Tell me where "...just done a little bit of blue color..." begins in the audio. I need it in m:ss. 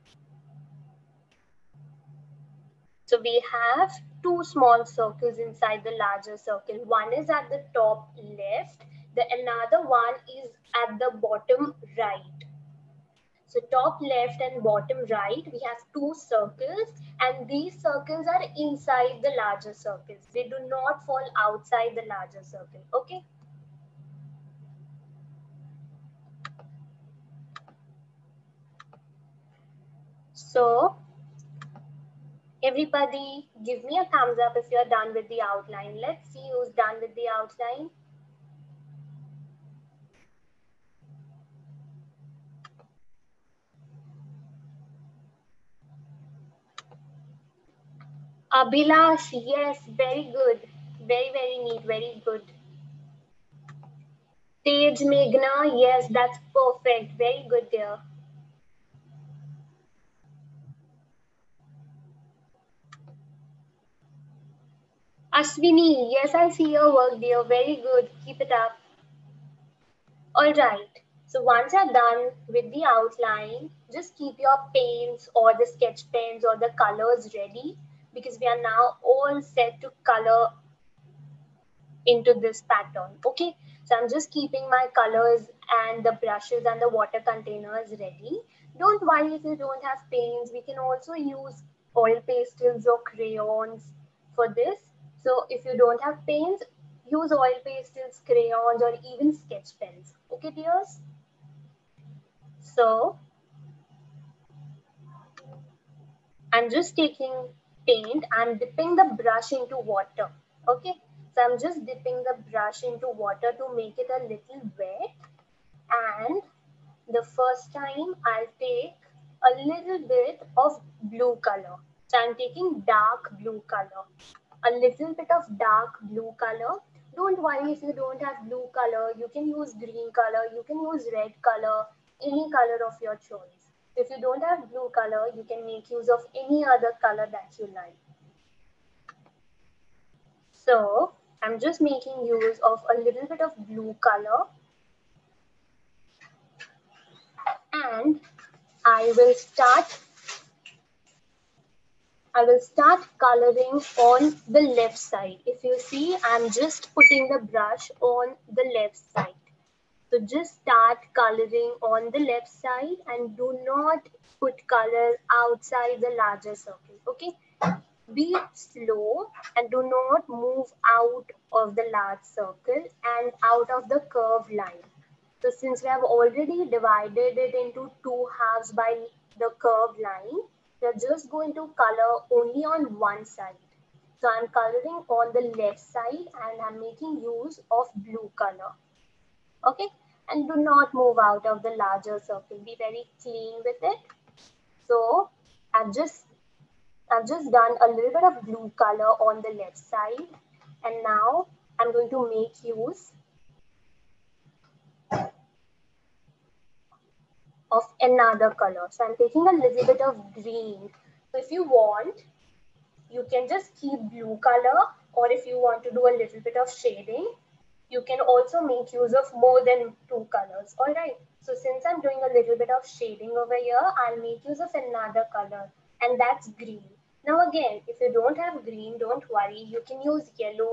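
3:17.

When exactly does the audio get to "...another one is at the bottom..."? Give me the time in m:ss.
0:09.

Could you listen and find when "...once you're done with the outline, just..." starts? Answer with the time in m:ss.
1:11.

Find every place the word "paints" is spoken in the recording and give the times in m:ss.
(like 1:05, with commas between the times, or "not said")
1:14, 1:30, 1:36, 1:47.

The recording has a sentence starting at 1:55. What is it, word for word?
And the first time I'll take a little bit of blue color.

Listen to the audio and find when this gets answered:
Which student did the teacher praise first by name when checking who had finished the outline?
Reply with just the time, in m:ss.
0:48.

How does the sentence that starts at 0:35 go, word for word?
Let's see who's done with the outline.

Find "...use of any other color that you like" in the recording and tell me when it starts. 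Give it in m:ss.
2:15.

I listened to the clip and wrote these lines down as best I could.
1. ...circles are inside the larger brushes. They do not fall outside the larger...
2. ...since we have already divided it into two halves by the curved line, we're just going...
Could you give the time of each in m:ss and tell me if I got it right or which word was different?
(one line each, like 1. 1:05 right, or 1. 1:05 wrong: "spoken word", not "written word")
1. 0:17 wrong: "circles", not "brushes"
2. 2:55 right.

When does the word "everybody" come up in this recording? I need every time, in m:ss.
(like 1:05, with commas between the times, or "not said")
0:32.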